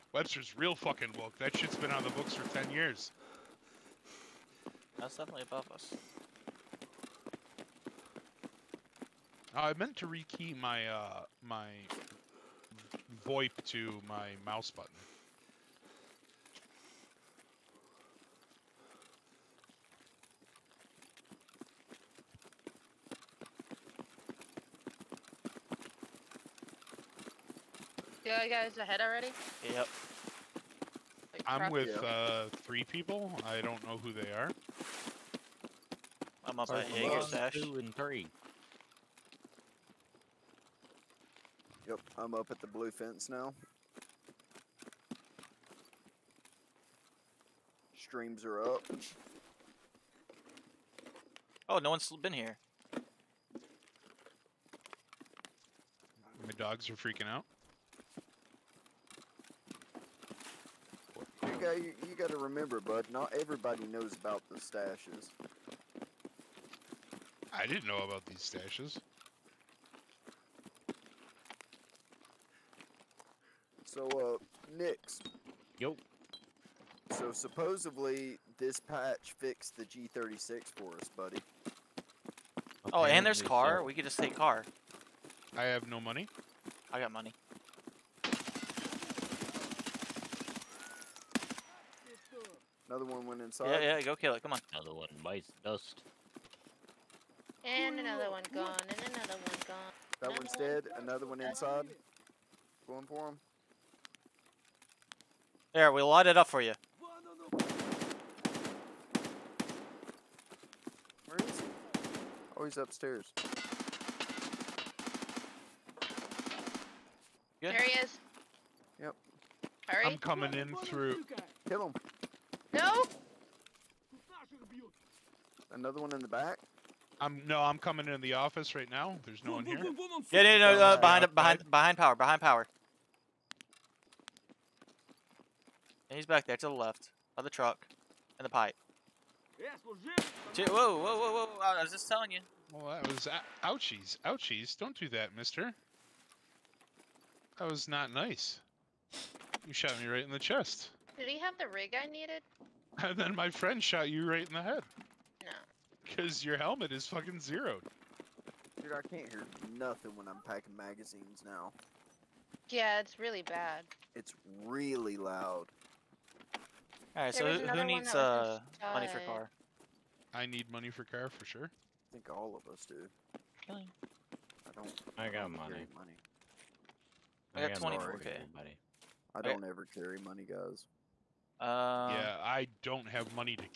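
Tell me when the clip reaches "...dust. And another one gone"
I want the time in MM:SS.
01:35.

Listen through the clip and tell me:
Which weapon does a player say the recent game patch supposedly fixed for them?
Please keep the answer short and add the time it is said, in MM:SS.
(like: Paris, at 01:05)
G36, at 01:19.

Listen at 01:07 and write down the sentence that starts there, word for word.
I didn't know about these stashes.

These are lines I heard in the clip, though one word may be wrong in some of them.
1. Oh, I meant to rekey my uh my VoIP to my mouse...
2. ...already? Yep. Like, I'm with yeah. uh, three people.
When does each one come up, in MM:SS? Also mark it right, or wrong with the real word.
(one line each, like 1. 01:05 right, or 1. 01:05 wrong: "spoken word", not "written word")
1. 00:09 right
2. 00:29 right.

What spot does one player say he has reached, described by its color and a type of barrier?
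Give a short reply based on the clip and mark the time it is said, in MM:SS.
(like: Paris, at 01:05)
the blue fence, at 00:42.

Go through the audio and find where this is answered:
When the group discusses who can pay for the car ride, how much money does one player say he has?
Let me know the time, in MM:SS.
02:57.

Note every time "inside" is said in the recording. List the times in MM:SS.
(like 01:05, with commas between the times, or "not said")
01:33, 01:41.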